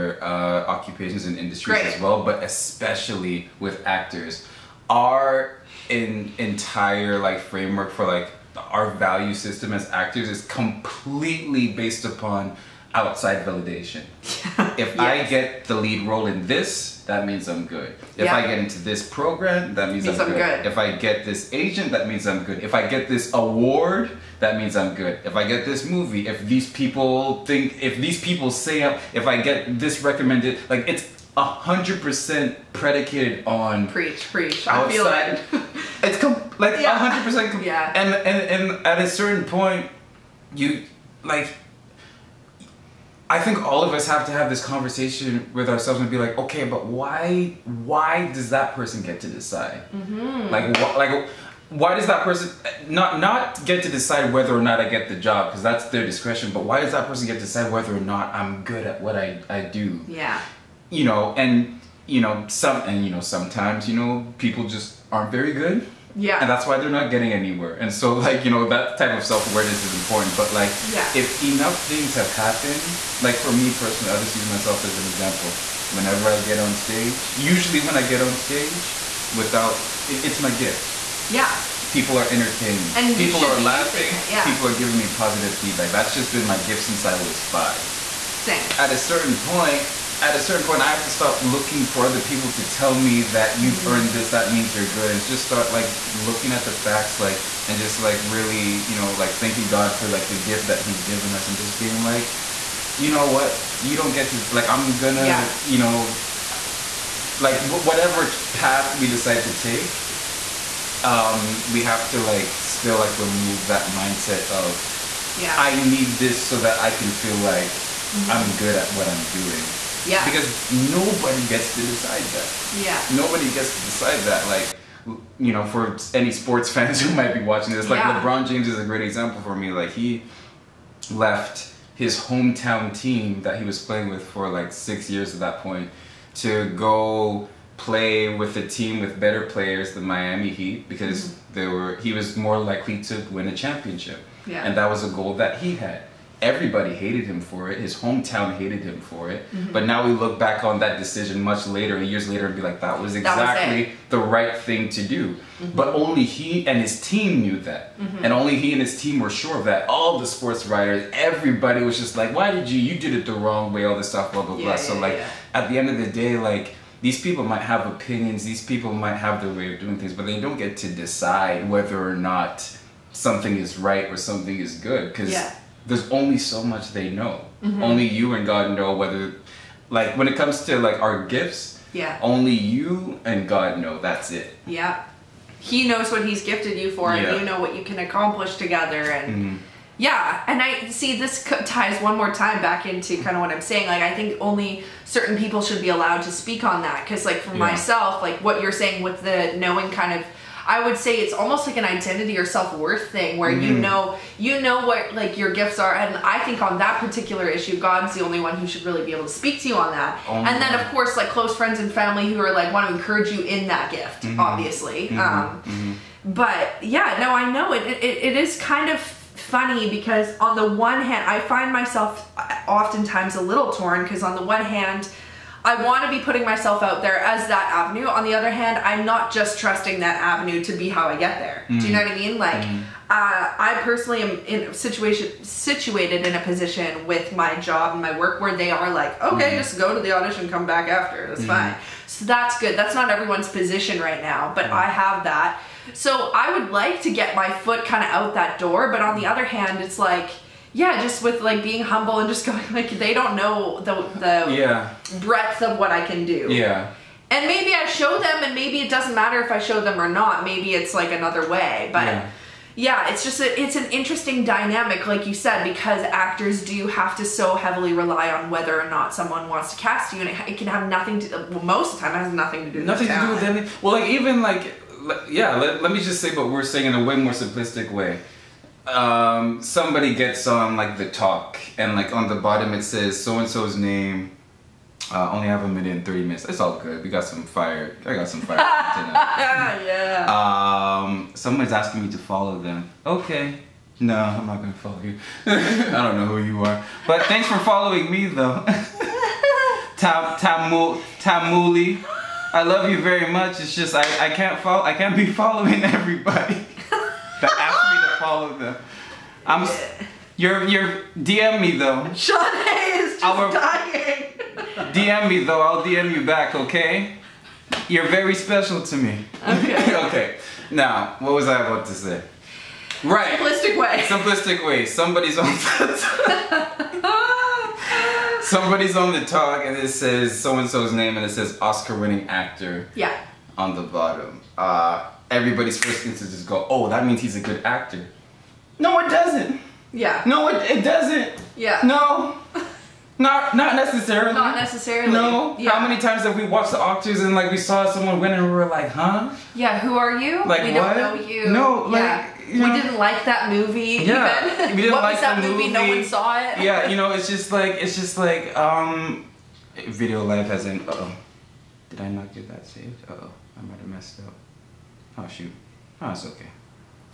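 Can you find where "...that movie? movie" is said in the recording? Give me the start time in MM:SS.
05:55.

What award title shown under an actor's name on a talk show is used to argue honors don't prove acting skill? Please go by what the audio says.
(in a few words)
Oscar.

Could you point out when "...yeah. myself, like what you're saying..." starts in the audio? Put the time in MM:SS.
03:17.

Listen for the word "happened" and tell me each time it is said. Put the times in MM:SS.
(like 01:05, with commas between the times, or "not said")
01:12.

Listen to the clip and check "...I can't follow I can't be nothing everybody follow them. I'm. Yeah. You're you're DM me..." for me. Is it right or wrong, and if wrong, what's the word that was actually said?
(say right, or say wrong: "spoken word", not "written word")
wrong: "following", not "nothing".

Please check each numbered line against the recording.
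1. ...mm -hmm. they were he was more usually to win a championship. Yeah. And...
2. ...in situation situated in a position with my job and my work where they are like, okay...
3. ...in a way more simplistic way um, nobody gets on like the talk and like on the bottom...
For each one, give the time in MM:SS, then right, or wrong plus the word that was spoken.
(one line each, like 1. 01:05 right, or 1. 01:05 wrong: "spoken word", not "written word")
1. 02:21 wrong: "likely", not "usually"
2. 03:54 right
3. 04:36 wrong: "somebody", not "nobody".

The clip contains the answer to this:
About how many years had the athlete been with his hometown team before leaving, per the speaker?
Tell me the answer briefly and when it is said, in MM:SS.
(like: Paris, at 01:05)
6, at 02:14.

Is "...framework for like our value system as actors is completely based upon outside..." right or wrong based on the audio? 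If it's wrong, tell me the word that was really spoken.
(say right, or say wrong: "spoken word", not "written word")
right.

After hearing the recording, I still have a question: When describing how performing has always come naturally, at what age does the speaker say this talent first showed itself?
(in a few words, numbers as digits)
5.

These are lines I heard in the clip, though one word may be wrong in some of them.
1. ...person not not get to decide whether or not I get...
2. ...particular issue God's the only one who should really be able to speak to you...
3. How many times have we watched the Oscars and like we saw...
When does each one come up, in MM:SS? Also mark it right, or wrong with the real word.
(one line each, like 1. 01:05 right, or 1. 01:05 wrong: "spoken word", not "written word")
1. 00:52 right
2. 03:27 right
3. 05:45 right.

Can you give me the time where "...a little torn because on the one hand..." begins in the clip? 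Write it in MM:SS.
03:43.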